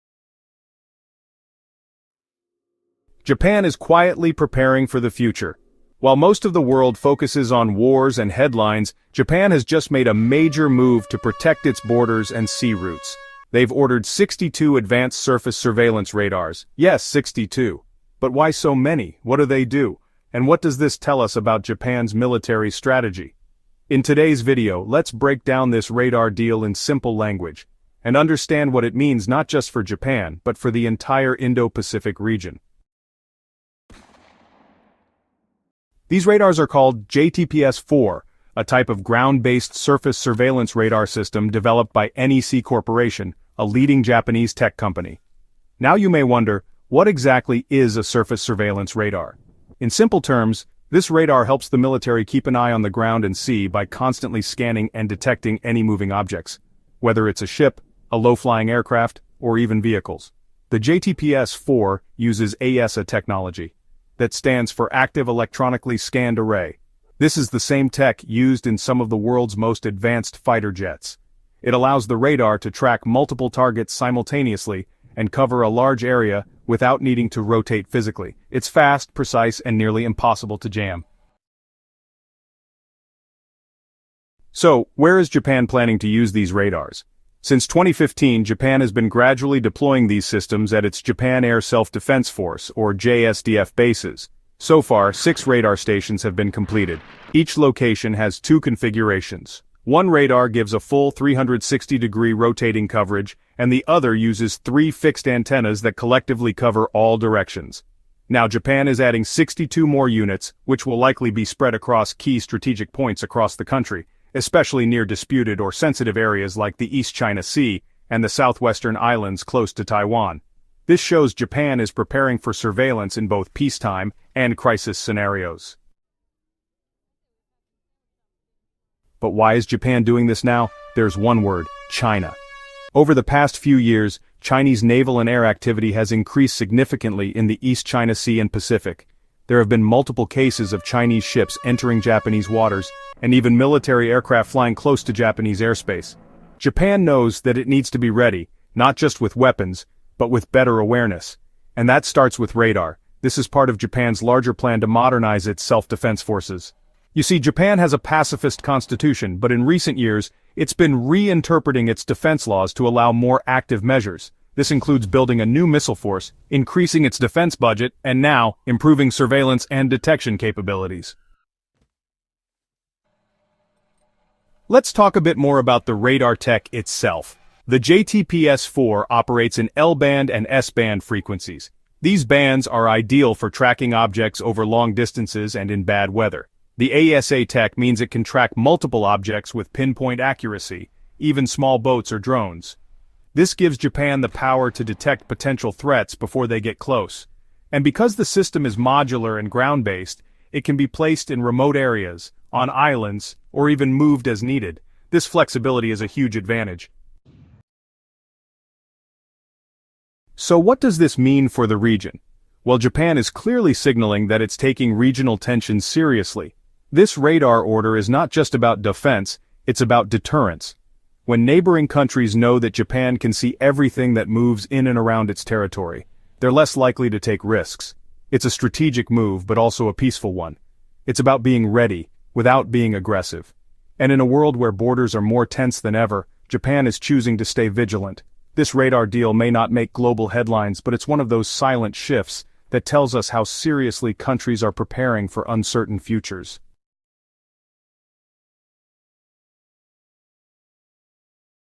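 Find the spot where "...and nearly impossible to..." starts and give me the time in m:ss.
1:19.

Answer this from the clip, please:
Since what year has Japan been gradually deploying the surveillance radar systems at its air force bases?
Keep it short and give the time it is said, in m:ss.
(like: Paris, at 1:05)
2015, at 1:27.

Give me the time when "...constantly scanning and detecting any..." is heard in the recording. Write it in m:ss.
0:53.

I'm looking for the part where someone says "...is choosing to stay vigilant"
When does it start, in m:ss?
3:56.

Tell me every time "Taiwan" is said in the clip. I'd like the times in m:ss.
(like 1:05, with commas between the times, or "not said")
1:59.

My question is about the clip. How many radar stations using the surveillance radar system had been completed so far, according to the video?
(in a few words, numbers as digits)
6.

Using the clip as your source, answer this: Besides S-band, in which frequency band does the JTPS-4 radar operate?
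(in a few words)
L-band.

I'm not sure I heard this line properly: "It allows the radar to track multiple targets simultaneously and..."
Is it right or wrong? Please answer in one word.
right.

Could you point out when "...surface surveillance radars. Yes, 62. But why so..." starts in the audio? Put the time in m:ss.
0:15.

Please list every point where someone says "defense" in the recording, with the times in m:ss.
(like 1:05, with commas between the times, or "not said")
1:31, 2:35, 2:42, 2:47, 3:38.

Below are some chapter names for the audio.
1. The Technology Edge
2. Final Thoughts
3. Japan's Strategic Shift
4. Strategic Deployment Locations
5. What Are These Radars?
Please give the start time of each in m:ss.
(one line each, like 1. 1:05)
1. 2:51
2. 3:27
3. 2:05
4. 1:21
5. 0:32.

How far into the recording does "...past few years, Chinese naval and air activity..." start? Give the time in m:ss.
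2:13.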